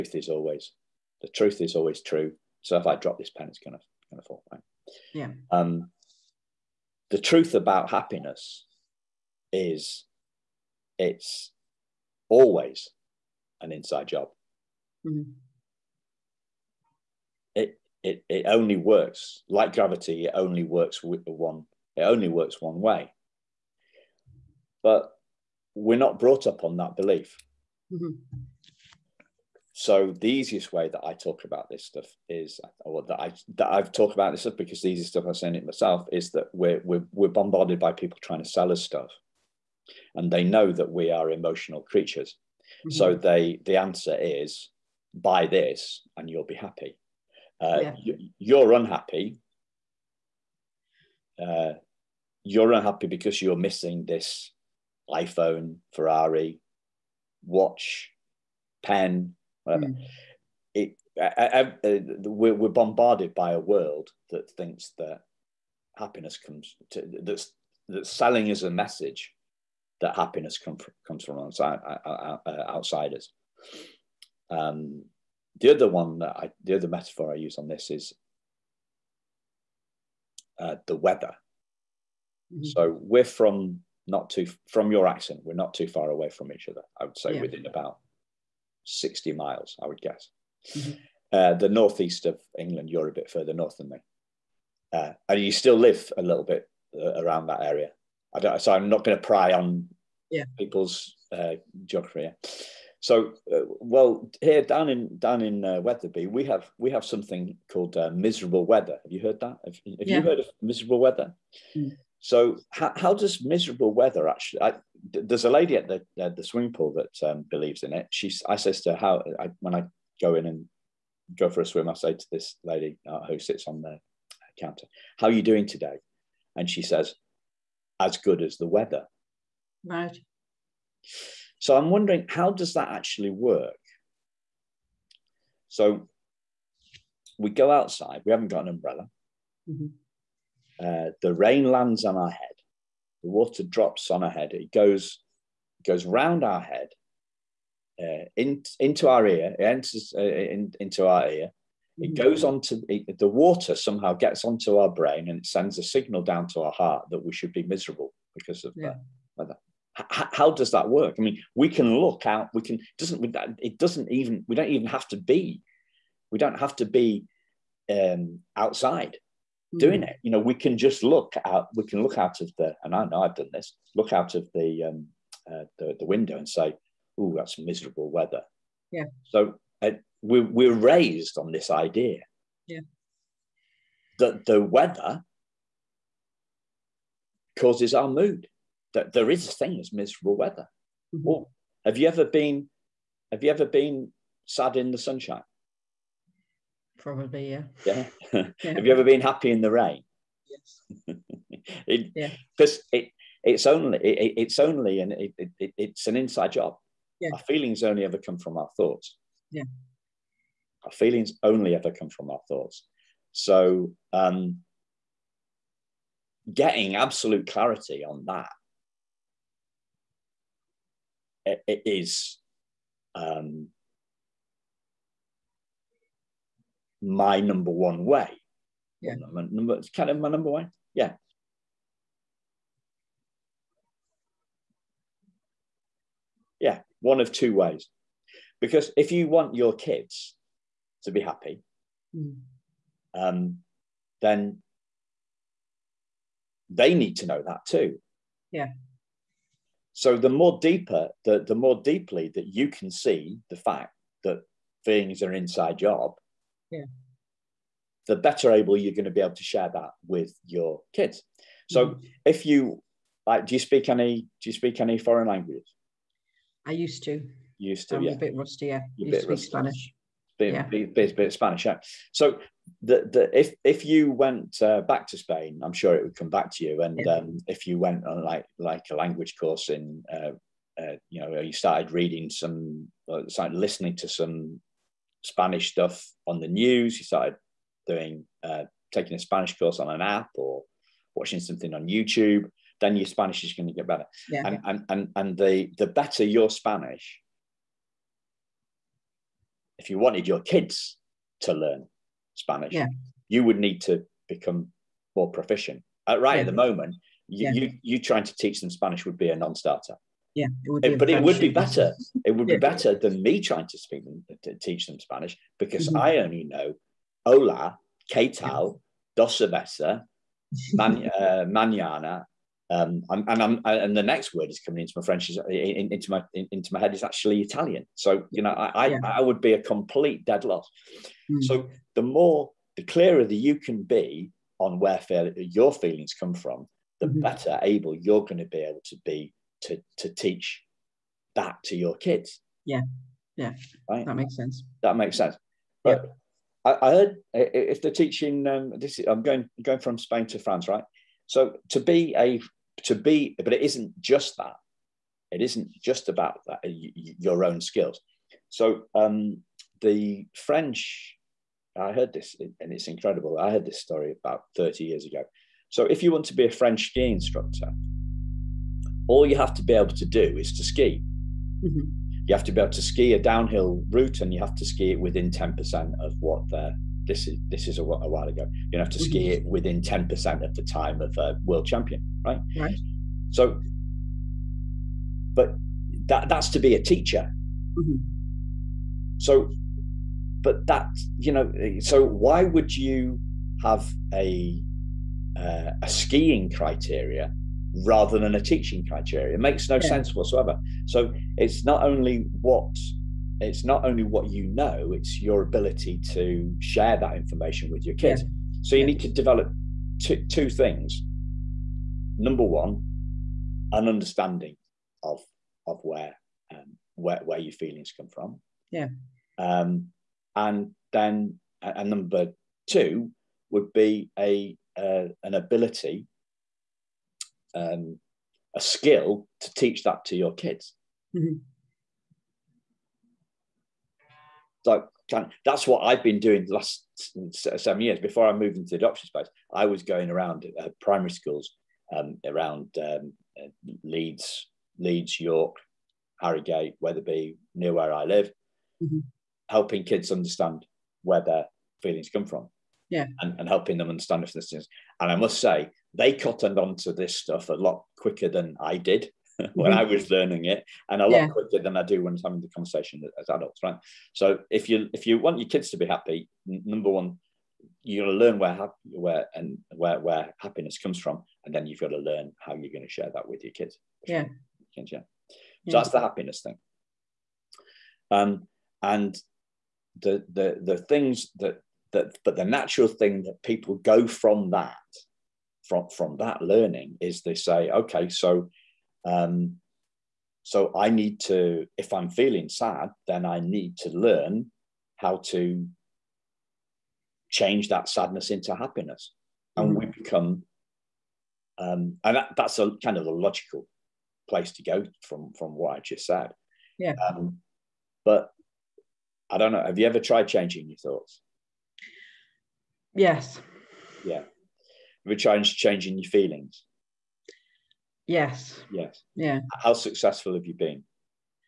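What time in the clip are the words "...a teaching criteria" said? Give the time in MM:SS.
06:38.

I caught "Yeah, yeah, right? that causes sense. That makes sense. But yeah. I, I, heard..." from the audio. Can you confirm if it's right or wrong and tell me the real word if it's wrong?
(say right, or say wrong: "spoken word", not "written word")
wrong: "makes", not "causes".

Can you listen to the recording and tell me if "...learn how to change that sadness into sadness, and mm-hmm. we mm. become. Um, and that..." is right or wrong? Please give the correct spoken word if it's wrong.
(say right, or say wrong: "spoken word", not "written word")
wrong: "happiness", not "sadness".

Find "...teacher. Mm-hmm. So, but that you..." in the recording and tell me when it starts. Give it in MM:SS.
06:26.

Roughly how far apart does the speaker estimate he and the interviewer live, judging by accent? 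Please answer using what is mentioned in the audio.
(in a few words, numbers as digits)
60 miles.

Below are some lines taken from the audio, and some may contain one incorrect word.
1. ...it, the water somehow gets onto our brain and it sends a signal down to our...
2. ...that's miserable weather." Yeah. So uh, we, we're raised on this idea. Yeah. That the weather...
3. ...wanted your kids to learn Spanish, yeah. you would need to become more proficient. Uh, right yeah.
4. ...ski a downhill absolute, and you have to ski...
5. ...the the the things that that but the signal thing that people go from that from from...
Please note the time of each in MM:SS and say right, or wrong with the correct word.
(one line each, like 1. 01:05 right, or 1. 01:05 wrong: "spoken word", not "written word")
1. 02:32 right
2. 02:57 right
3. 04:59 right
4. 06:12 wrong: "route", not "absolute"
5. 08:00 wrong: "natural", not "signal".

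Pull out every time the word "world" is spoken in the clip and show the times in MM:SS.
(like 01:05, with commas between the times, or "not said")
01:03, 06:21.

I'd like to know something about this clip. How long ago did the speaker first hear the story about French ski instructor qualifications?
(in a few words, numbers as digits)
30 years.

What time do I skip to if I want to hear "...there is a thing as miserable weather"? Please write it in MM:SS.
03:09.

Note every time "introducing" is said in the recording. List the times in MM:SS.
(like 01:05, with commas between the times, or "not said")
not said.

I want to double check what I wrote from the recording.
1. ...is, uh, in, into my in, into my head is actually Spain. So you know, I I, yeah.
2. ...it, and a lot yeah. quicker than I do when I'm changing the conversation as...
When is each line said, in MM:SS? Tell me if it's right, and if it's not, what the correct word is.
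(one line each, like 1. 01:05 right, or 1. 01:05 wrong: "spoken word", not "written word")
1. 05:25 wrong: "Italian", not "Spain"
2. 07:40 wrong: "having", not "changing".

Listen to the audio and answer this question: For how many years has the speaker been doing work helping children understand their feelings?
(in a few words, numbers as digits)
7 years.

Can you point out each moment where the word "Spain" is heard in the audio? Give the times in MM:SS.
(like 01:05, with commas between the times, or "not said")
04:35, 05:49.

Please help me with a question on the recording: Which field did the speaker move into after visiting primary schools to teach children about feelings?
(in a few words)
adoption.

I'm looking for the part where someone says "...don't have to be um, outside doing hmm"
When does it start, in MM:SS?
02:46.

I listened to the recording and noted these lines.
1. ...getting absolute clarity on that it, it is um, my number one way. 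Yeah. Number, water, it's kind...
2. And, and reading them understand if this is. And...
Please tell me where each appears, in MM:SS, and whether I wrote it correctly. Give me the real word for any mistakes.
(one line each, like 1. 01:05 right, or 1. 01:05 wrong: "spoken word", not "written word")
1. 03:36 wrong: "number", not "water"
2. 07:33 wrong: "helping", not "reading".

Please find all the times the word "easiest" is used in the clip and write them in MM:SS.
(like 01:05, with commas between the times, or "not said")
00:30, 00:34.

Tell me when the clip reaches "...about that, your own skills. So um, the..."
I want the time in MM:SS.
05:56.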